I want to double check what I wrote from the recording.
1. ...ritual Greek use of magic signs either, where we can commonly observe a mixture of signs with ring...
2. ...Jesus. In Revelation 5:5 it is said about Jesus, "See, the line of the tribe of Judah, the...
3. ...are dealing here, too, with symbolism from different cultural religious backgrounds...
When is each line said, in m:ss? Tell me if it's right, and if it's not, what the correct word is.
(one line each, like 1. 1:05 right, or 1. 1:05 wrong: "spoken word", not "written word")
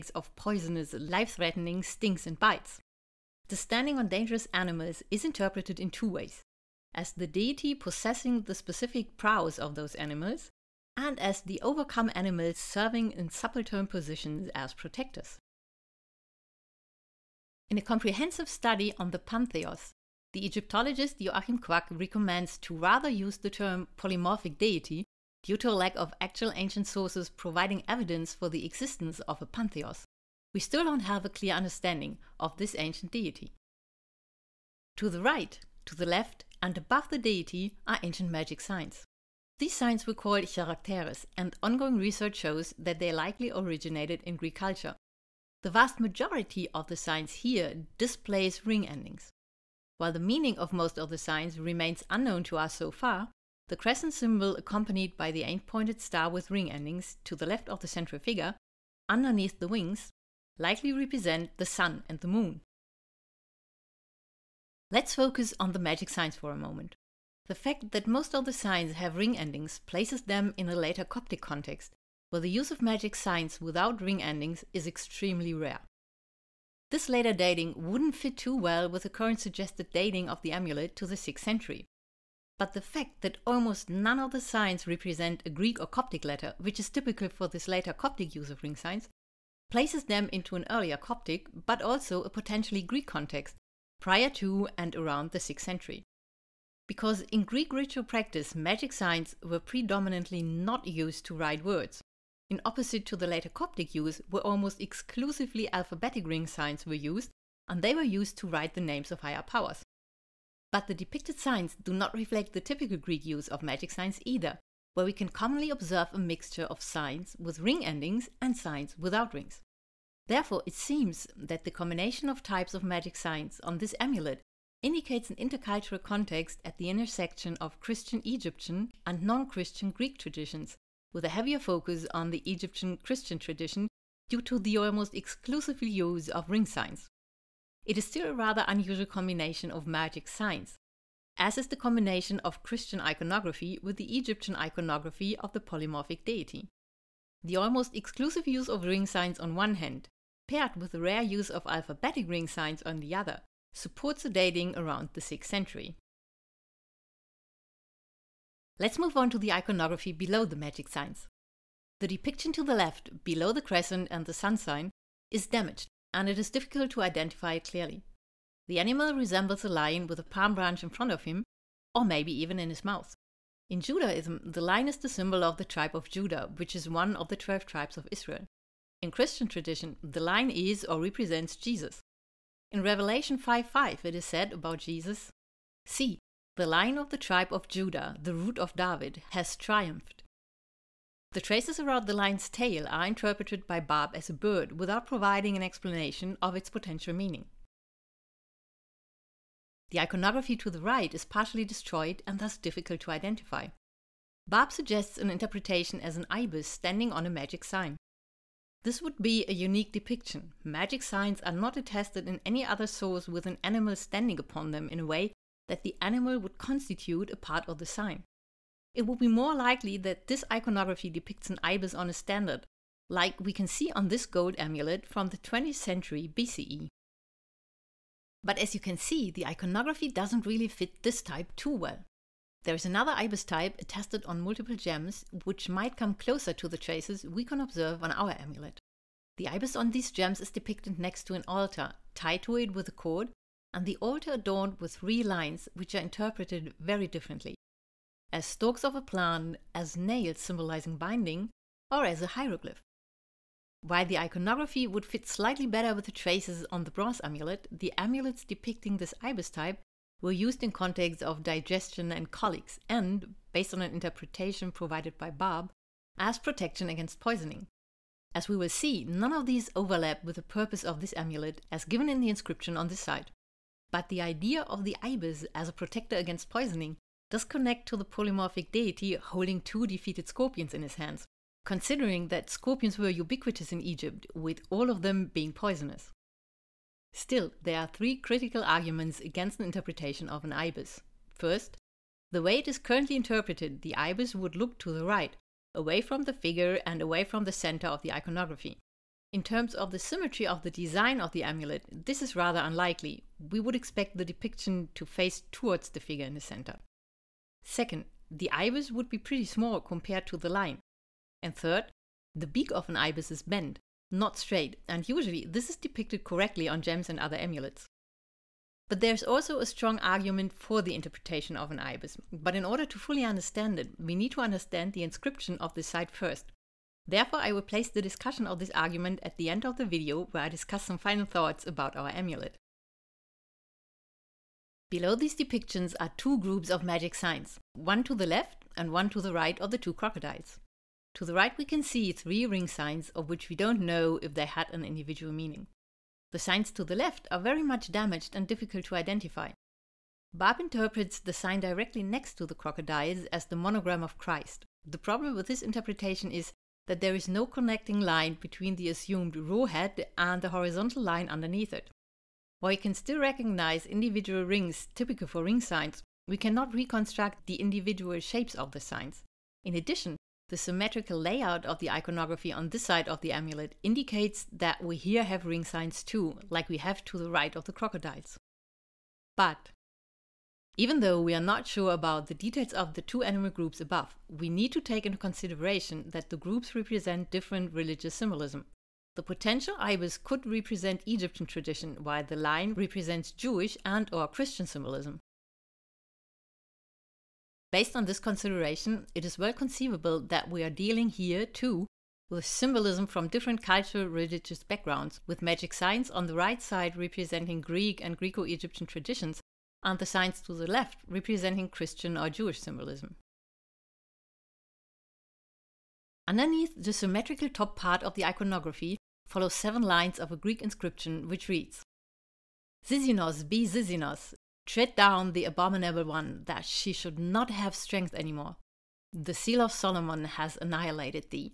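1. 1:52 wrong: "typical", not "ritual"
2. 3:01 right
3. 6:40 right.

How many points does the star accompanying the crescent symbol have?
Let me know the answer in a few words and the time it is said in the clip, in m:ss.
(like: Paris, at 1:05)
8, at 0:55.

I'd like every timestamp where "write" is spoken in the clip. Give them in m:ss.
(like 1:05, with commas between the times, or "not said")
1:41, 1:48.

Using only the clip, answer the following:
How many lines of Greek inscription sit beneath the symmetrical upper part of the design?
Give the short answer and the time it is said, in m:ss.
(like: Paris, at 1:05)
7, at 6:59.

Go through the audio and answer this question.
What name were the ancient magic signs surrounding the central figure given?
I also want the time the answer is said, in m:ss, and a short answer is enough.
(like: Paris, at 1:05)
characteres, at 0:40.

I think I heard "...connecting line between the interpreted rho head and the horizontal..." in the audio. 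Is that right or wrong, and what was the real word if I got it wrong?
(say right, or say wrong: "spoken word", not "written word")
wrong: "assumed", not "interpreted".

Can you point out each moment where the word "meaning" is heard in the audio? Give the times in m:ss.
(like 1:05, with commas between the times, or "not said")
0:50, 3:17, 5:45.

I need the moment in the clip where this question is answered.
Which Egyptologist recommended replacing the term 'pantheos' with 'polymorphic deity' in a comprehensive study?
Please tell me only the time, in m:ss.
0:21.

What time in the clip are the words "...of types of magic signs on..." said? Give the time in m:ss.
2:02.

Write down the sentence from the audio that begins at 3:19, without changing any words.
The iconography to the right is partially destroyed and thus difficult to identify.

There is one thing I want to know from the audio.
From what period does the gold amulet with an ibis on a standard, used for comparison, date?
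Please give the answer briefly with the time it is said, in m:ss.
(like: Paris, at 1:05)
20th century BCE, at 3:45.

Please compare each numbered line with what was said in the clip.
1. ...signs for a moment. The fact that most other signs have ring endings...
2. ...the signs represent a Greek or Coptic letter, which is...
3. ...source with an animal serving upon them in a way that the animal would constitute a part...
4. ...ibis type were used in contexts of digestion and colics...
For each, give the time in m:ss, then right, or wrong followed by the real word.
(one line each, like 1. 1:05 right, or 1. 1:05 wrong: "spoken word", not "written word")
1. 1:06 right
2. 1:24 right
3. 3:32 wrong: "standing", not "serving"
4. 4:19 right.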